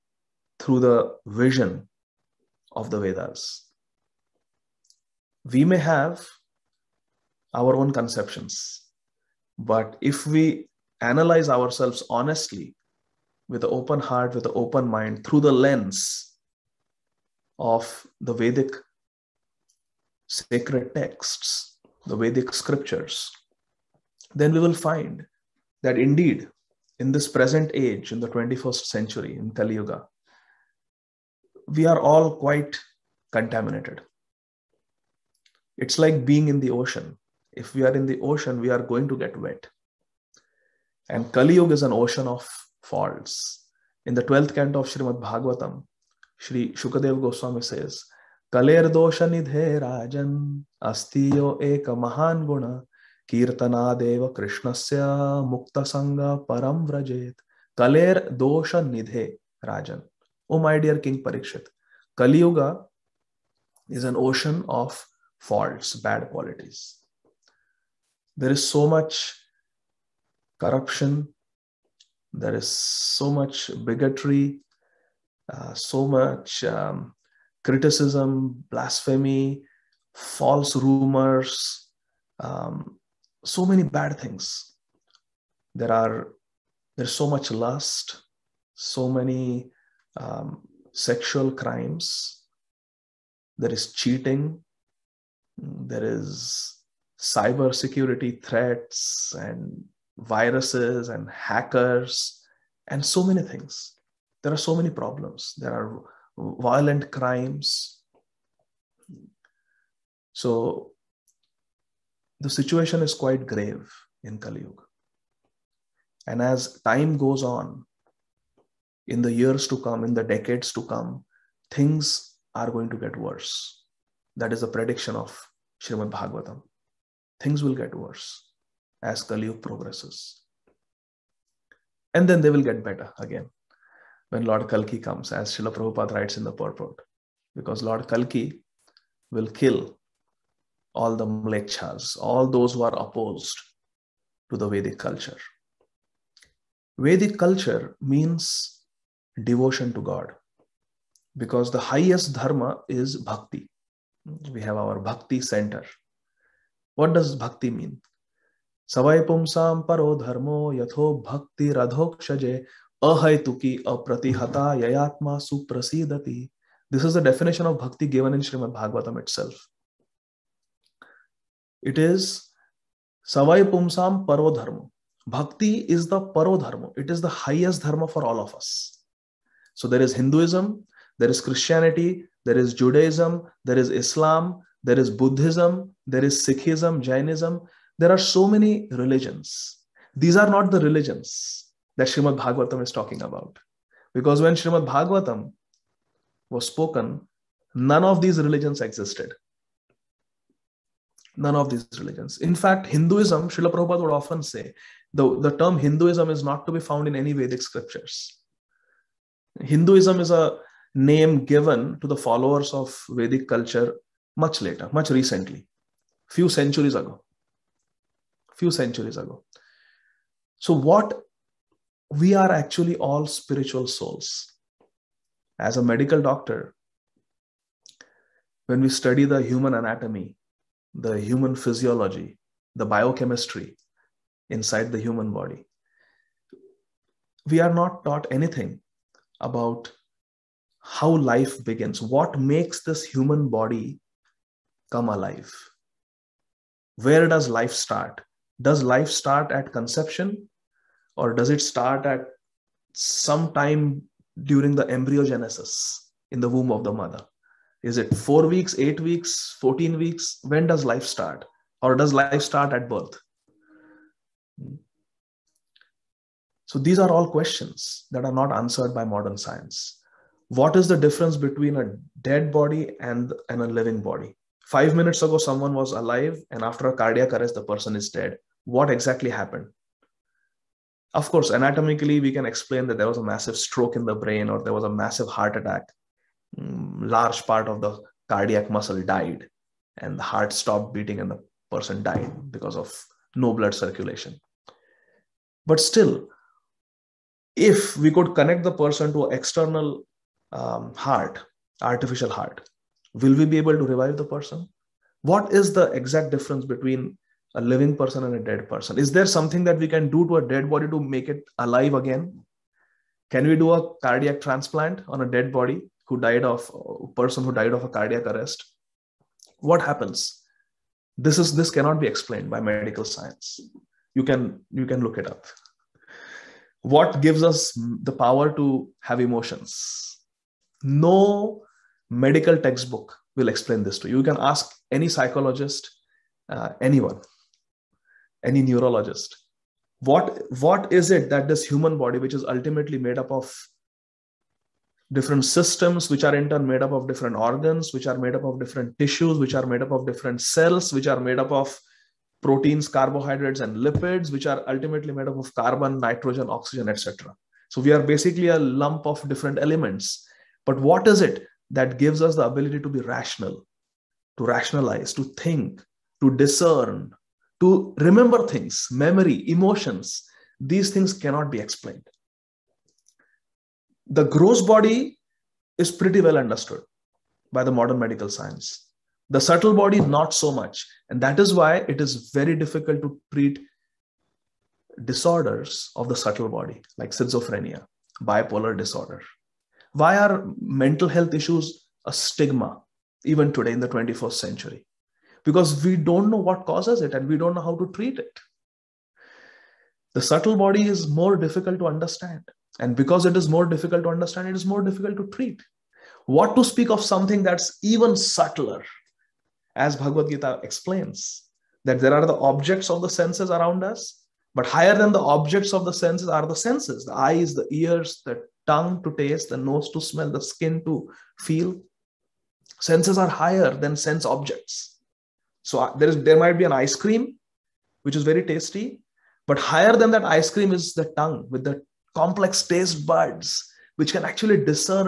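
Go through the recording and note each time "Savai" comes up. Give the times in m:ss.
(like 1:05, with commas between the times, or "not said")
2:38, 2:53.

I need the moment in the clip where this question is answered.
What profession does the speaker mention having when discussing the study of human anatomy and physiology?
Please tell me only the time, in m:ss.
3:45.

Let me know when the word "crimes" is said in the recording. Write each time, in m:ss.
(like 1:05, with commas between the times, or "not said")
1:31, 1:47.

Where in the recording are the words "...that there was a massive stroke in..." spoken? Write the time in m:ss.
4:42.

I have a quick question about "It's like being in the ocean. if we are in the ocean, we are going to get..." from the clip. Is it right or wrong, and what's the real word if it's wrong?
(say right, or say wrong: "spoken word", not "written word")
right.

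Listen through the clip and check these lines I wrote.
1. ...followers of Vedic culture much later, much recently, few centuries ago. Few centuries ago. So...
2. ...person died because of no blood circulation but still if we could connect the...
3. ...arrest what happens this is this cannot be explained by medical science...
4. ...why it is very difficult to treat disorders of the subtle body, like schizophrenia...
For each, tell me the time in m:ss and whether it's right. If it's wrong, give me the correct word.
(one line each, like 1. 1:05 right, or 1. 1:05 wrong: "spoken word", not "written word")
1. 3:32 right
2. 4:51 right
3. 5:18 right
4. 6:21 right.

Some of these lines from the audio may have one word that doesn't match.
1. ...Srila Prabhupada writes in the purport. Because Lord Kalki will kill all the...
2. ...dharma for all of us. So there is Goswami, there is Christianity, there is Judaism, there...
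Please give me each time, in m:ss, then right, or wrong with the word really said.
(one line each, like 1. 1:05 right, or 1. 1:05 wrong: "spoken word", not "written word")
1. 2:15 right
2. 2:57 wrong: "Hinduism", not "Goswami".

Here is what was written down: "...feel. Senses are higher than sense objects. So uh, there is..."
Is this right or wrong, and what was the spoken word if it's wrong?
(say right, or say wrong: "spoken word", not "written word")
right.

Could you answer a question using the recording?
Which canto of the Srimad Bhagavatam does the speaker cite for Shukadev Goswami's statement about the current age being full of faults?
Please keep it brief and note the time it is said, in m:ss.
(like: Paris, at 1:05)
12th canto, at 0:44.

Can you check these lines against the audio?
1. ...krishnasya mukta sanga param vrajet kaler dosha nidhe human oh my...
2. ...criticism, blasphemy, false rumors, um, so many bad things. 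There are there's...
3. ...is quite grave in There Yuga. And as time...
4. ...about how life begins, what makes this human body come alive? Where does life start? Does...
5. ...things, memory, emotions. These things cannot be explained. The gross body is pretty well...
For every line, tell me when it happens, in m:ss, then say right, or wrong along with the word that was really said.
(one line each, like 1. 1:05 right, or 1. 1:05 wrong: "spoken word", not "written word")
1. 0:54 wrong: "rajan", not "human"
2. 1:17 right
3. 1:53 wrong: "Kali", not "There"
4. 3:59 right
5. 6:08 right.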